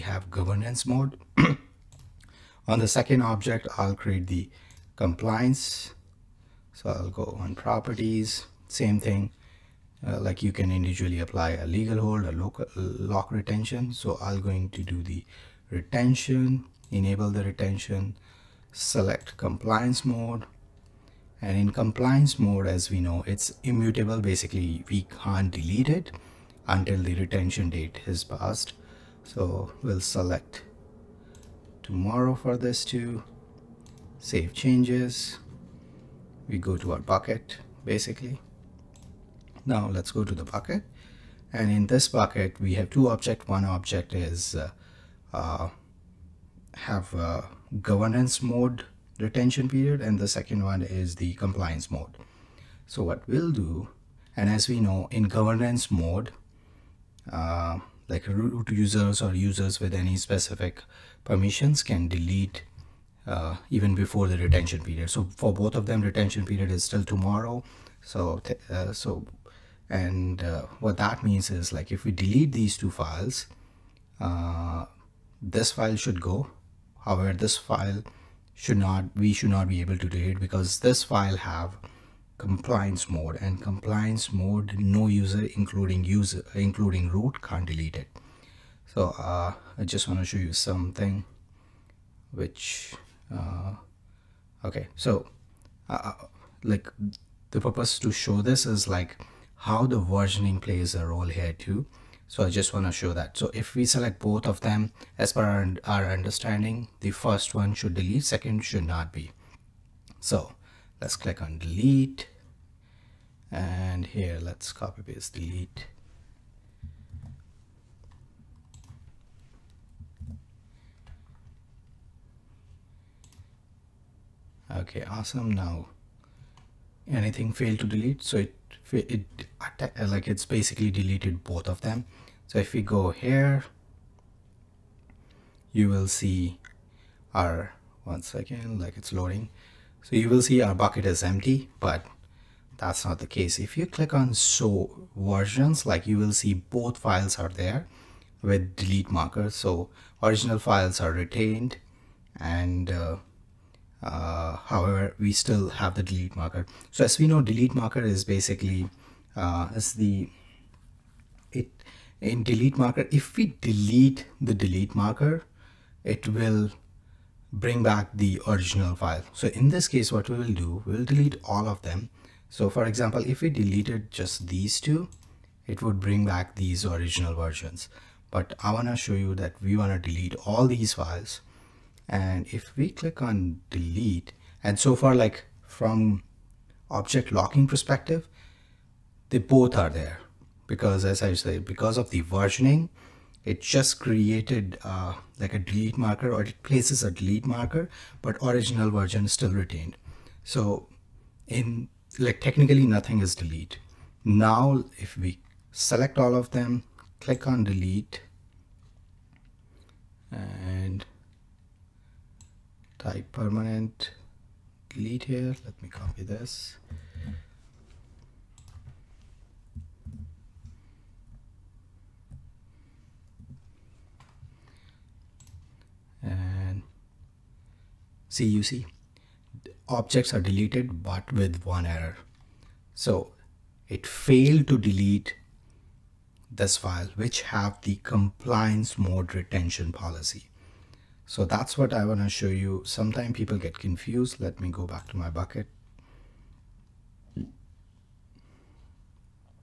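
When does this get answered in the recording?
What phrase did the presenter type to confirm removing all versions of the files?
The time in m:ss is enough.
3:33.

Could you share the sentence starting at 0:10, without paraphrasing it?
Uh, like you can individually apply a legal hold, a local lock retention.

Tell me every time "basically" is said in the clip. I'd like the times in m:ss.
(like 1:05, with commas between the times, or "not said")
0:24, 0:37, 2:10, 2:38.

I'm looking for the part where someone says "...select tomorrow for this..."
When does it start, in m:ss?
0:29.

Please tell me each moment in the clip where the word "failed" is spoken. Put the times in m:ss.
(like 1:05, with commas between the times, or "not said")
2:07, 3:54.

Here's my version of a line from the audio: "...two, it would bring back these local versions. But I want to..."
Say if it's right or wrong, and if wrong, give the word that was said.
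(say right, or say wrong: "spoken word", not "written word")
wrong: "original", not "local".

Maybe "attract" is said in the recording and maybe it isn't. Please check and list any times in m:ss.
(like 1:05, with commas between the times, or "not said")
not said.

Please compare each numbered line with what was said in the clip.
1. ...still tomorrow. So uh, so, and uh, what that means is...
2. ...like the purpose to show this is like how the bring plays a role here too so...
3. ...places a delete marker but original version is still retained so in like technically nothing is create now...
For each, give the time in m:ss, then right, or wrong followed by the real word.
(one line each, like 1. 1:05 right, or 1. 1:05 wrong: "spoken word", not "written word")
1. 1:06 right
2. 1:36 wrong: "versioning", not "bring"
3. 3:16 wrong: "delete", not "create".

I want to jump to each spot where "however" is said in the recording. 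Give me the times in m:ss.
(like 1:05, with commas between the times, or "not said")
1:17, 2:34.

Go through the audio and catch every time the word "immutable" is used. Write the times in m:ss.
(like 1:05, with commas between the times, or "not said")
0:23.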